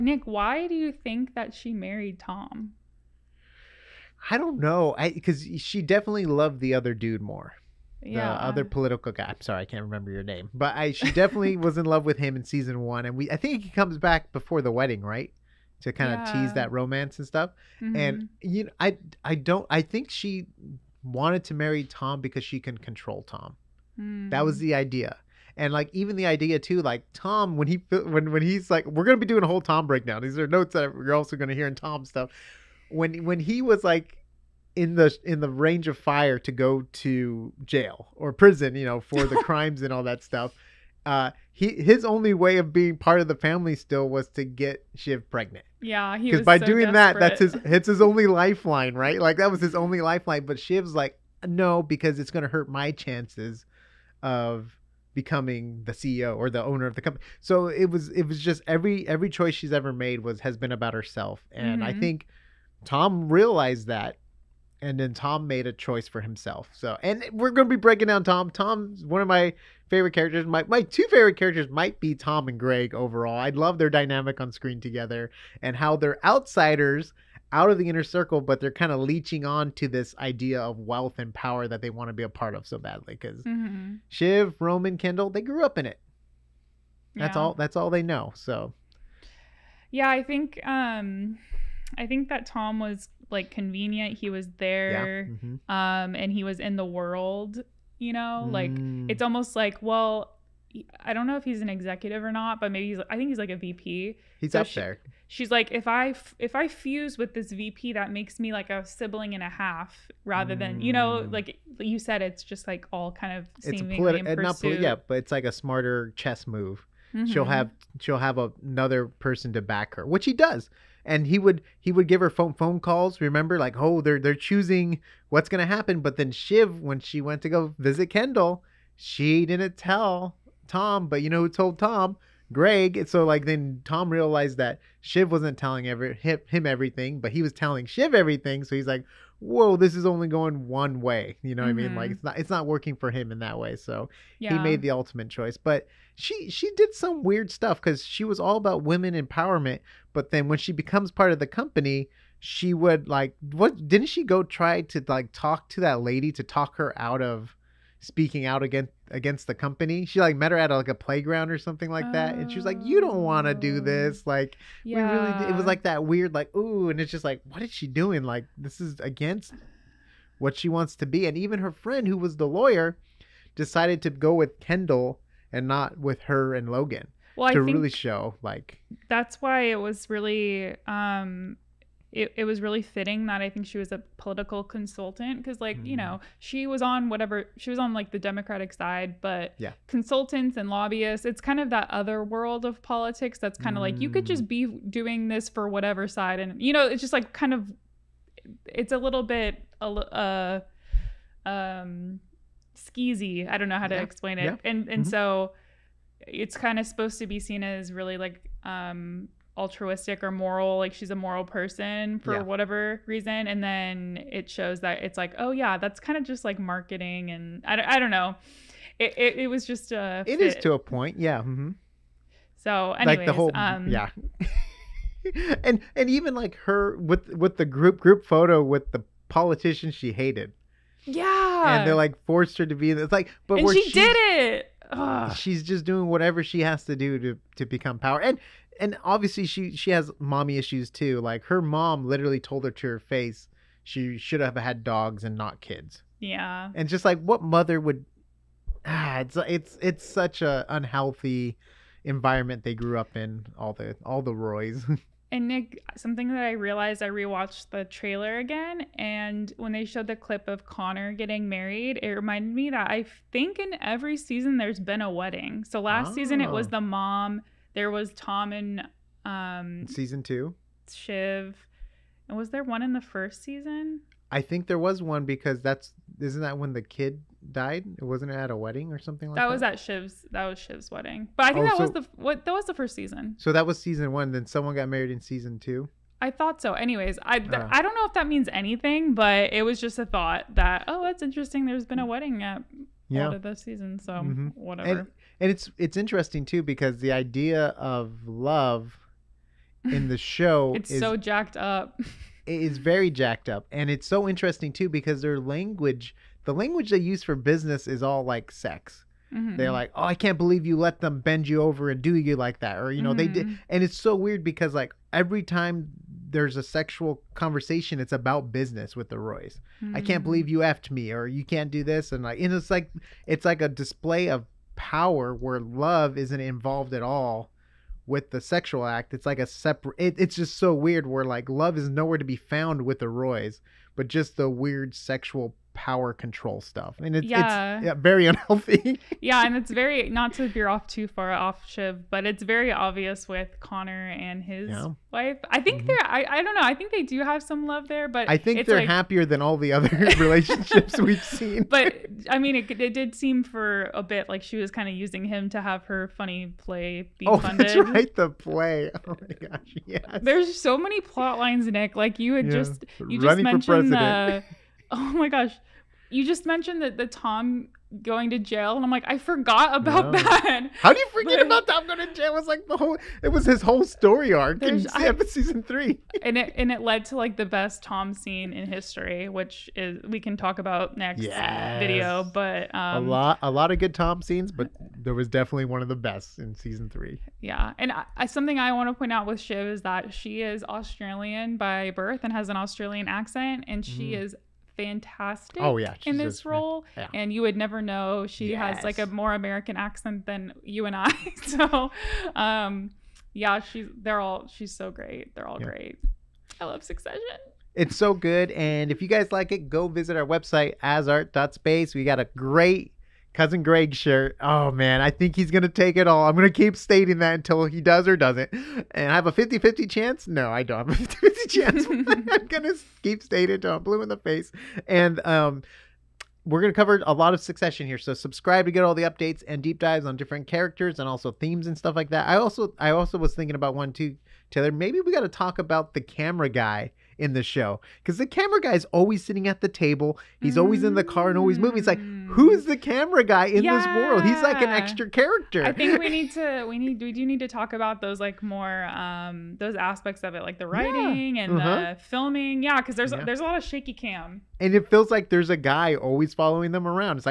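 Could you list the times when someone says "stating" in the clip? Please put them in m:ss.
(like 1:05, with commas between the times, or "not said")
6:56, 7:03.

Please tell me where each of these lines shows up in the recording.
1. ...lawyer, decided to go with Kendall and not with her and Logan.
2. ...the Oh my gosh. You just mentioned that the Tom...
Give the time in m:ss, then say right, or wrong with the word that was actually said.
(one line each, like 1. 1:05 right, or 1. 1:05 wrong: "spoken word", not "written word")
1. 2:52 right
2. 6:03 right.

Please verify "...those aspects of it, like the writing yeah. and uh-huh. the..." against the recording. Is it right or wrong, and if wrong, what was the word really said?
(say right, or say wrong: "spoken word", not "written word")
right.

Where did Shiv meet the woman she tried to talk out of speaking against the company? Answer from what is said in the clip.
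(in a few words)
a playground.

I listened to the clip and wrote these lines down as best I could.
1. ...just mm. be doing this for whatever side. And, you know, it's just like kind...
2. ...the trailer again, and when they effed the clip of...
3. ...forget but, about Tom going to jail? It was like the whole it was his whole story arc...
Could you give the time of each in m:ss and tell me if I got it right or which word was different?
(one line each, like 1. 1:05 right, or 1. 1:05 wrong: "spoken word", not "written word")
1. 3:14 right
2. 4:17 wrong: "showed", not "effed"
3. 6:11 right.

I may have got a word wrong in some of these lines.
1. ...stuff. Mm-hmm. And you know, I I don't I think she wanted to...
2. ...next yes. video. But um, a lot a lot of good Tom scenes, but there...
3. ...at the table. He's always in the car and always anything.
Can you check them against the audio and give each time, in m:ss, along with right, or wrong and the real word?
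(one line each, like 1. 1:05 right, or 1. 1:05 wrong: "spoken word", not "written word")
1. 0:17 right
2. 6:20 right
3. 7:19 wrong: "moving", not "anything".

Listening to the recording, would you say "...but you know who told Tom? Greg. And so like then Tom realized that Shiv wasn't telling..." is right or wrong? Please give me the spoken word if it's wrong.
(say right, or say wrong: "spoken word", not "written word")
right.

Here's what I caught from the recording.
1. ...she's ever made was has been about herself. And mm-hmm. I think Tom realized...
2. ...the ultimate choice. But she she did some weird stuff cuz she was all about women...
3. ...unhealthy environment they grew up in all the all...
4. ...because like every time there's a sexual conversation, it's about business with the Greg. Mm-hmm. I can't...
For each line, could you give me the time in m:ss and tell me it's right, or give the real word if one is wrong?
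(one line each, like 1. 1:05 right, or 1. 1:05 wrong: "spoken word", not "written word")
1. 0:59 right
2. 2:24 right
3. 4:10 right
4. 5:14 wrong: "Roys", not "Greg".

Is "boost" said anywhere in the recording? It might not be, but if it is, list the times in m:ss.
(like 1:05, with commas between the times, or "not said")
not said.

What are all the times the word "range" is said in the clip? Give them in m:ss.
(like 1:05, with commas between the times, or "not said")
0:35.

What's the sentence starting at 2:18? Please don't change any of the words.
So he's like, "Whoa, this is only going one way." You know mm-hmm.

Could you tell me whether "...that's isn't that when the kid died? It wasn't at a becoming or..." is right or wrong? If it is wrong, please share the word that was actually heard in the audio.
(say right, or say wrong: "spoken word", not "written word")
wrong: "wedding", not "becoming".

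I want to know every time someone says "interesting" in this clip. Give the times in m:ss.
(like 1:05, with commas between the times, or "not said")
4:51, 4:55, 5:04.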